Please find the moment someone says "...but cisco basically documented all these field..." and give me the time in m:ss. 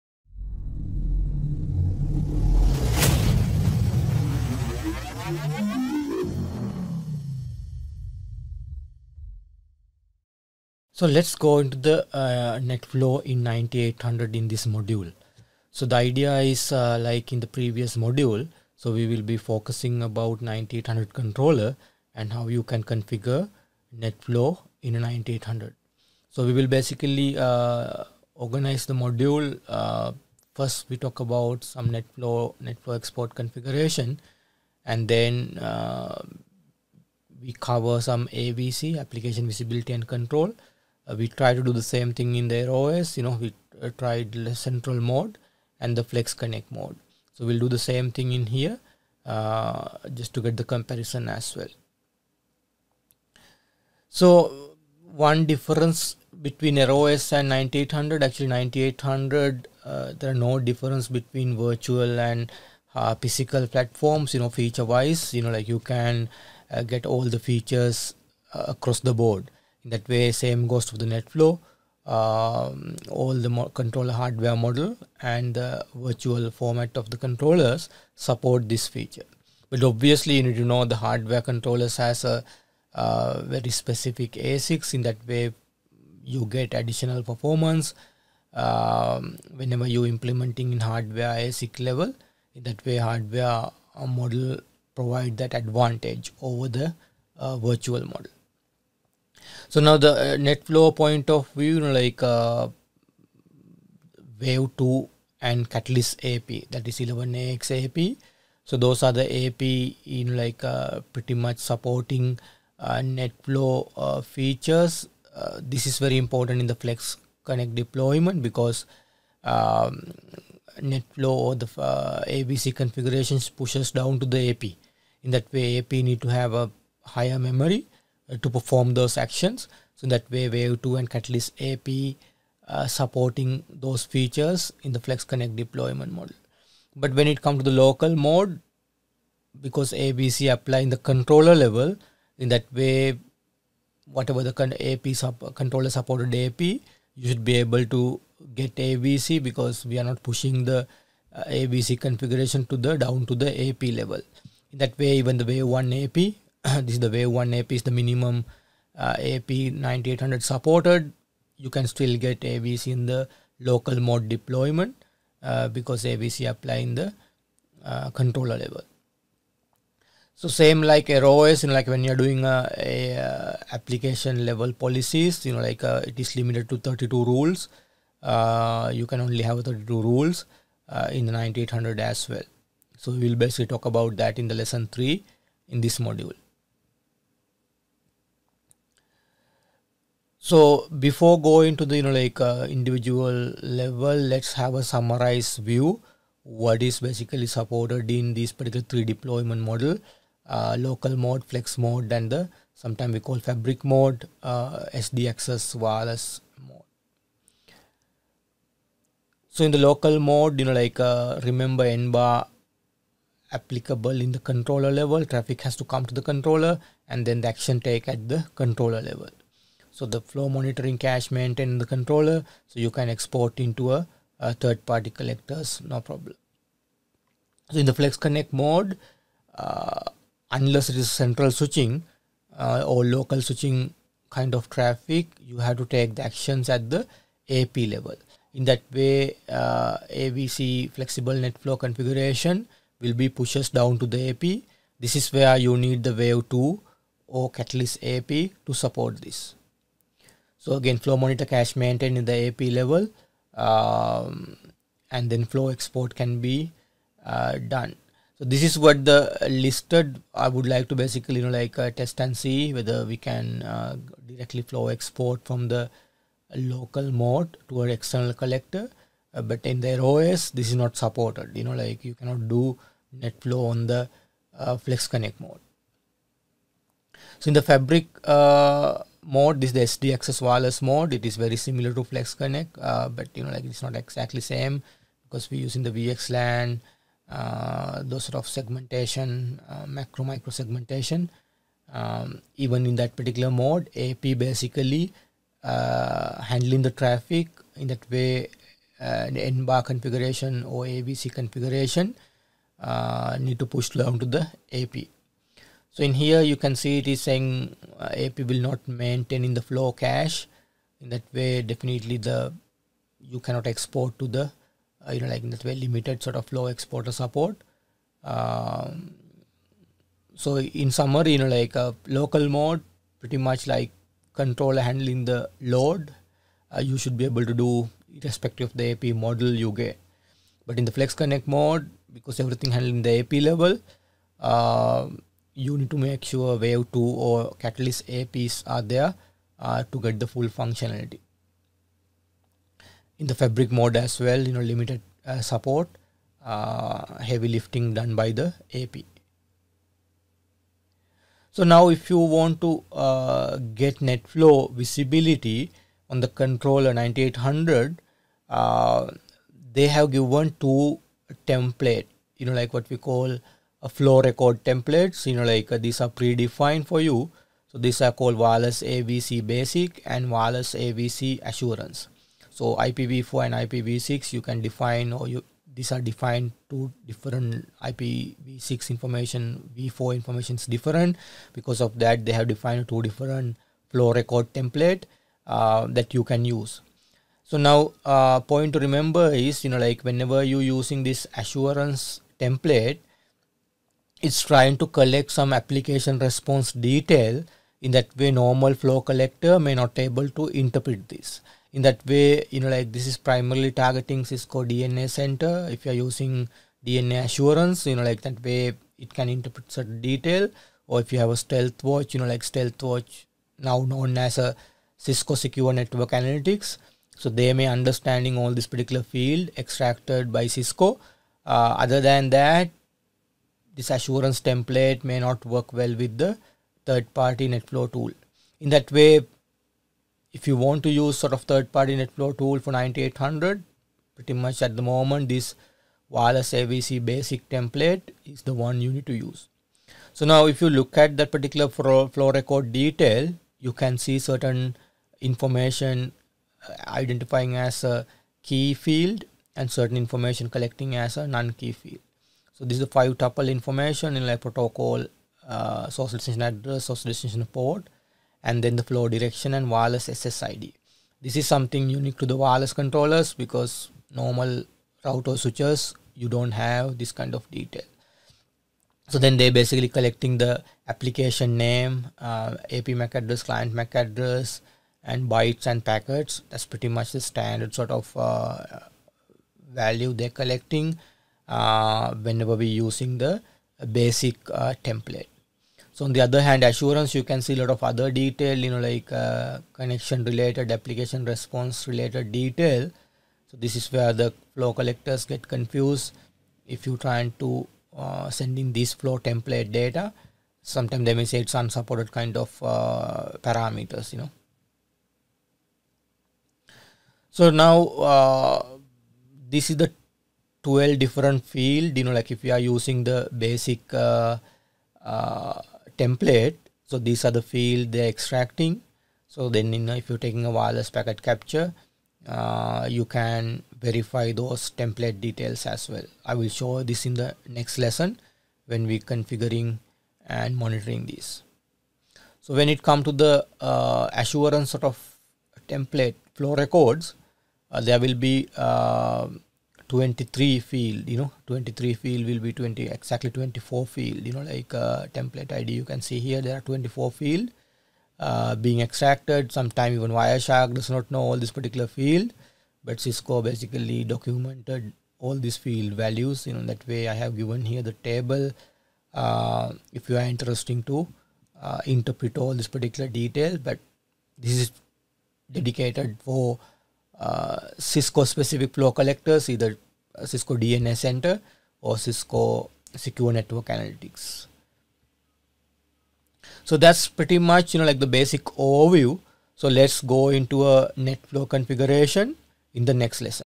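9:12.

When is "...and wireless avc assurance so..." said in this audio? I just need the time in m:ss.
6:10.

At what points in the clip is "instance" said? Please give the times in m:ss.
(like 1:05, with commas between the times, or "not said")
not said.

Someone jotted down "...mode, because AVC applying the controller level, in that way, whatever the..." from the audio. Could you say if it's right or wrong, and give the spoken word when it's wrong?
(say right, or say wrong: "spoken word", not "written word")
right.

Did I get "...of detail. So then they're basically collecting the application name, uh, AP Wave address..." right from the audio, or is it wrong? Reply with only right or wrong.
wrong.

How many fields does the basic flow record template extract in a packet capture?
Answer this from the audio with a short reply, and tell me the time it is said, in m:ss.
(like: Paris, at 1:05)
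12, at 8:30.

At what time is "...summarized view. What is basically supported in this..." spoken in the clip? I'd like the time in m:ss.
3:14.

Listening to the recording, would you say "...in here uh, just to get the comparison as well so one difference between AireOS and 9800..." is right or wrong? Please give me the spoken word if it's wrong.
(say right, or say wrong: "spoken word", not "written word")
right.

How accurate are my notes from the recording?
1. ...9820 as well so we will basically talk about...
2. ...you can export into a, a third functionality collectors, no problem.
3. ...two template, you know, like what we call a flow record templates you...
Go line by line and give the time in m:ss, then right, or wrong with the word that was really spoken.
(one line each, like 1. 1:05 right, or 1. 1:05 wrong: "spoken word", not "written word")
1. 3:01 wrong: "9800", not "9820"
2. 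3:42 wrong: "party", not "functionality"
3. 6:00 right.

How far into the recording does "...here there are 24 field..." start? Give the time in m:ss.
9:06.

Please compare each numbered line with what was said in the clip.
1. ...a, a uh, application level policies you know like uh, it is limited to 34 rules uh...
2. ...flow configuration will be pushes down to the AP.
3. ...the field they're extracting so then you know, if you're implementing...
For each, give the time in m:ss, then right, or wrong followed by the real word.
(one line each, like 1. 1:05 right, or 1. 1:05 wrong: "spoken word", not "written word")
1. 2:52 wrong: "32", not "34"
2. 4:01 right
3. 8:37 wrong: "taking", not "implementing".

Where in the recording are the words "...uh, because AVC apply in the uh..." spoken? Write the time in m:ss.
2:45.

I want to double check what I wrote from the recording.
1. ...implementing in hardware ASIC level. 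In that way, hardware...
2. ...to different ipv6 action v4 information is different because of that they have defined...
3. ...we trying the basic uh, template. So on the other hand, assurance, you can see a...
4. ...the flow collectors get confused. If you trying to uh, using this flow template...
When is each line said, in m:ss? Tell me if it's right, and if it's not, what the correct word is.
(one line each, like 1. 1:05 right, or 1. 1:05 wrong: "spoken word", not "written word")
1. 1:30 right
2. 6:16 wrong: "information", not "action"
3. 8:02 wrong: "using", not "trying"
4. 8:14 wrong: "sending", not "using".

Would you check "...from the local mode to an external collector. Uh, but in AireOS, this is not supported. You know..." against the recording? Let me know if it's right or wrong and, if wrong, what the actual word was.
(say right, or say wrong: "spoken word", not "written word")
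right.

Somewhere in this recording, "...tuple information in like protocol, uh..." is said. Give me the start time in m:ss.
7:33.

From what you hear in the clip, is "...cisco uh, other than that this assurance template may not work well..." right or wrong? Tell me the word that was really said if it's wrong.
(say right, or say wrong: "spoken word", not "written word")
right.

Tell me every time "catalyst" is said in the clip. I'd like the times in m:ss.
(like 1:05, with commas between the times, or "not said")
1:45, 2:11, 4:07, 5:37.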